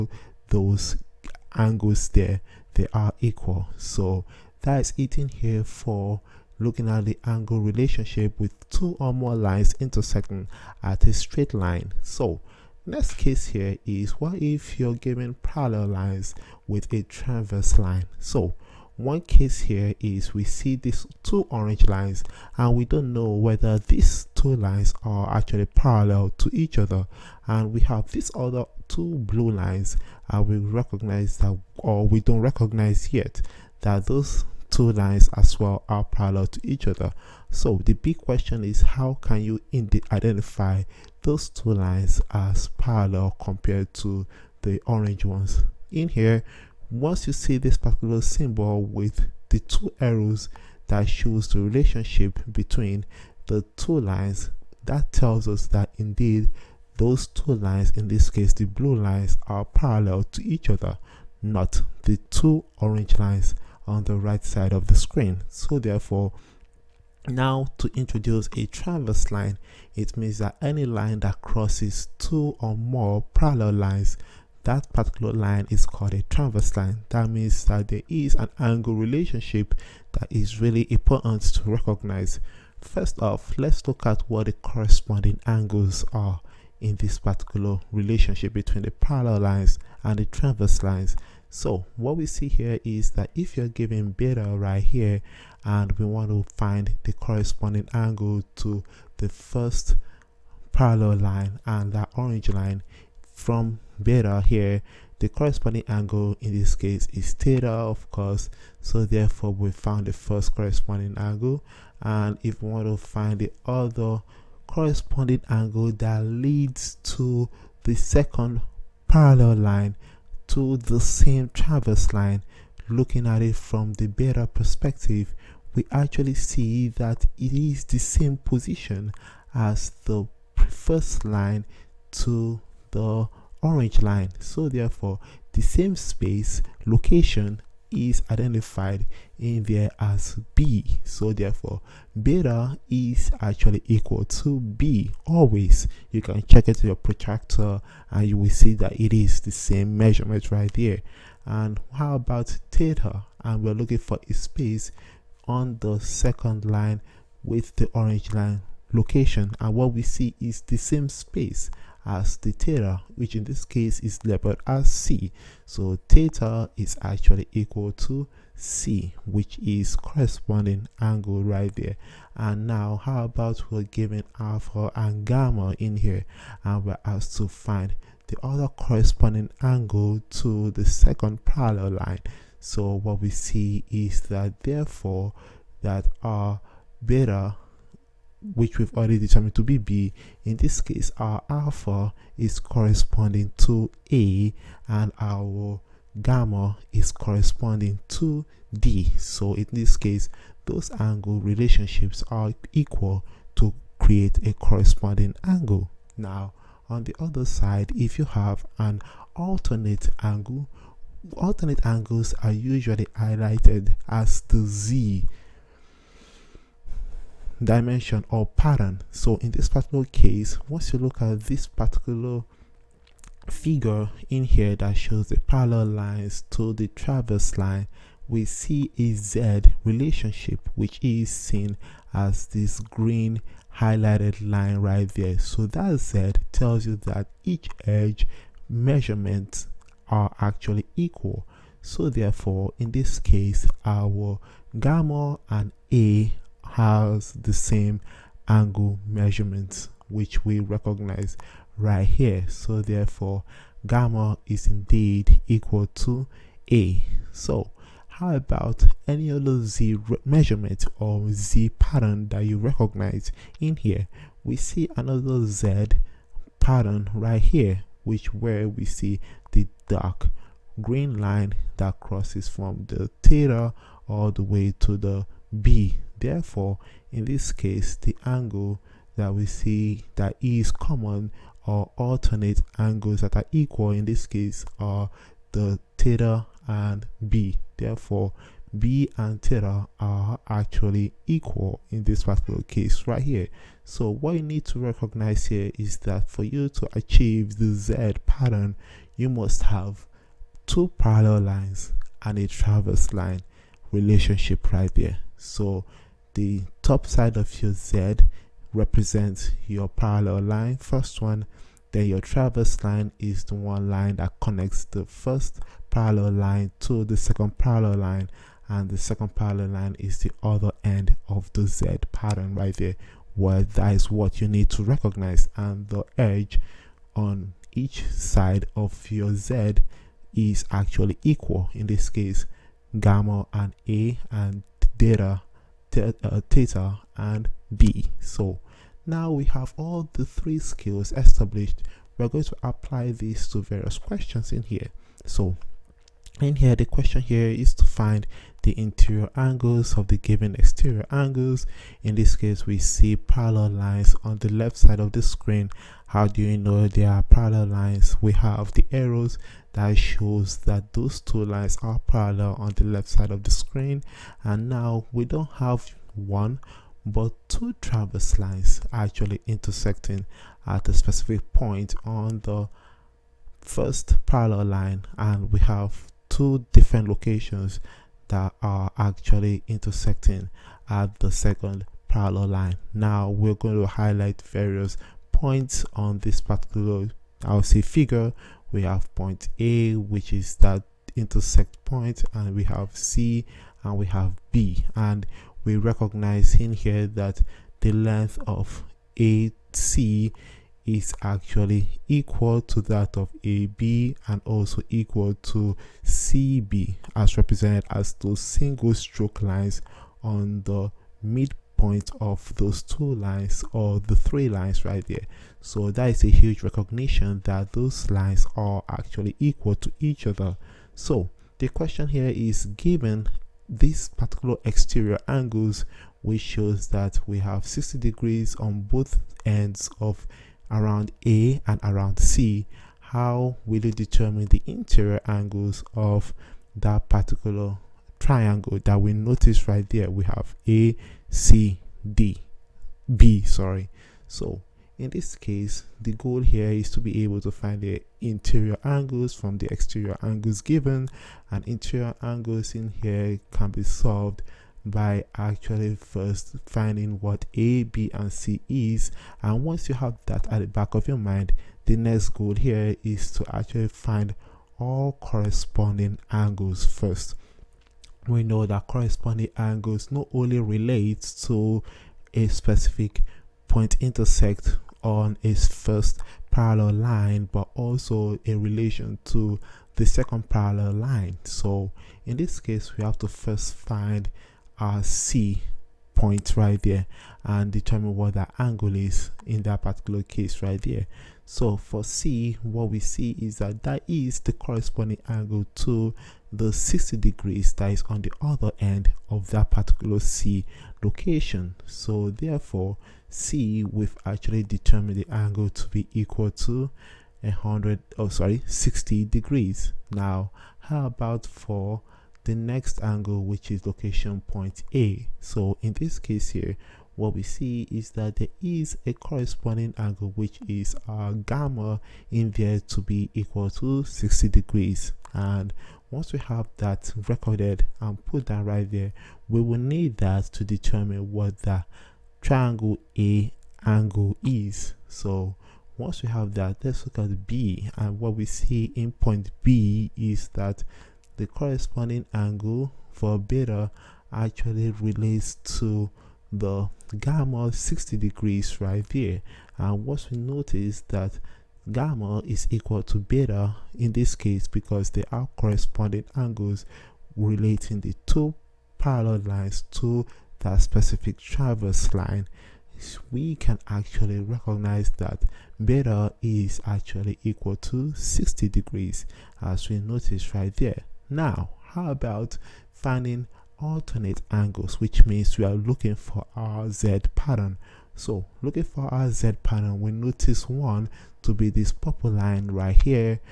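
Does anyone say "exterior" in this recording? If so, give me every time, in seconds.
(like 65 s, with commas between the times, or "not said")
350 s, 424 s, 449 s.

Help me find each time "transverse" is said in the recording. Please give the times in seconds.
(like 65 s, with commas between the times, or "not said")
17 s, 76 s, 90 s.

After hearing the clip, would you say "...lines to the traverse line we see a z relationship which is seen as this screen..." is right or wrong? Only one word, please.
wrong.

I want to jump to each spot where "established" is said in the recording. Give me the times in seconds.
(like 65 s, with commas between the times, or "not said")
341 s.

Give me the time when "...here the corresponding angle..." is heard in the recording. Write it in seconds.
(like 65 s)
104 s.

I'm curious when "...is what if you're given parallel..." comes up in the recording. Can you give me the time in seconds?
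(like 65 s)
13 s.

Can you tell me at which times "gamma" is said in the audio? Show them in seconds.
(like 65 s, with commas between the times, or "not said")
175 s, 196 s, 244 s, 253 s, 332 s, 521 s, 547 s, 551 s.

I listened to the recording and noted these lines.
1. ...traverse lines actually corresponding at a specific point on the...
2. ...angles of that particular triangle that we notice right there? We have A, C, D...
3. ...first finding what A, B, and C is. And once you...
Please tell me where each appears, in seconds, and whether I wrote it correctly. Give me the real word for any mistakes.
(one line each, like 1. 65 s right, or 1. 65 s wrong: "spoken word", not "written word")
1. 367 s wrong: "intersecting", not "corresponding"
2. 435 s right
3. 455 s right.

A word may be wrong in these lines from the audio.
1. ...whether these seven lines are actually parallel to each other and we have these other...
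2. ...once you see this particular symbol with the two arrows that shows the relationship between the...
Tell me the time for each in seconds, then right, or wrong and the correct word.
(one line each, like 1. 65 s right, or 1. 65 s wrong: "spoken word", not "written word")
1. 23 s wrong: "two", not "seven"
2. 46 s right.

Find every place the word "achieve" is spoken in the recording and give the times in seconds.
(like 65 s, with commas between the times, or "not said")
296 s.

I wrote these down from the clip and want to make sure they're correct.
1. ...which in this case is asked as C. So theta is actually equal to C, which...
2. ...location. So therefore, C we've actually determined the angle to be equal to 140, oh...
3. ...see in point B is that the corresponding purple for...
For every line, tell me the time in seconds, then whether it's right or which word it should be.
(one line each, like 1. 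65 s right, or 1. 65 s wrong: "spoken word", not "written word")
1. 163 s wrong: "labeled", not "asked"
2. 501 s wrong: "100", not "140"
3. 538 s wrong: "angle", not "purple".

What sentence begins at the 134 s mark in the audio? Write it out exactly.
So therefore, the same space location is identified in there as B.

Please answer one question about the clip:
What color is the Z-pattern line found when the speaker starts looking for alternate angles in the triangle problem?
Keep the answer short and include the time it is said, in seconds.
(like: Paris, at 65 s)
purple, at 581 s.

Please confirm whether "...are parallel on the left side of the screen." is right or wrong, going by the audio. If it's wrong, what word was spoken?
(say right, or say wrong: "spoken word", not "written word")
right.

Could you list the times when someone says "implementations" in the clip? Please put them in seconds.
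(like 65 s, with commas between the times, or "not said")
not said.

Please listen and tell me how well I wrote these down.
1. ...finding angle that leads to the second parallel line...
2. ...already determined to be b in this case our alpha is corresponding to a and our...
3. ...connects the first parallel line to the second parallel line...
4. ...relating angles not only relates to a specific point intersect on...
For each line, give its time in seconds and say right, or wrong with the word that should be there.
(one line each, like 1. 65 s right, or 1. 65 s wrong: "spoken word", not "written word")
1. 114 s wrong: "corresponding", not "finding"
2. 188 s right
3. 314 s right
4. 468 s wrong: "corresponding", not "relating".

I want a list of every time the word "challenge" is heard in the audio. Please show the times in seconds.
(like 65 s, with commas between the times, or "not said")
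not said.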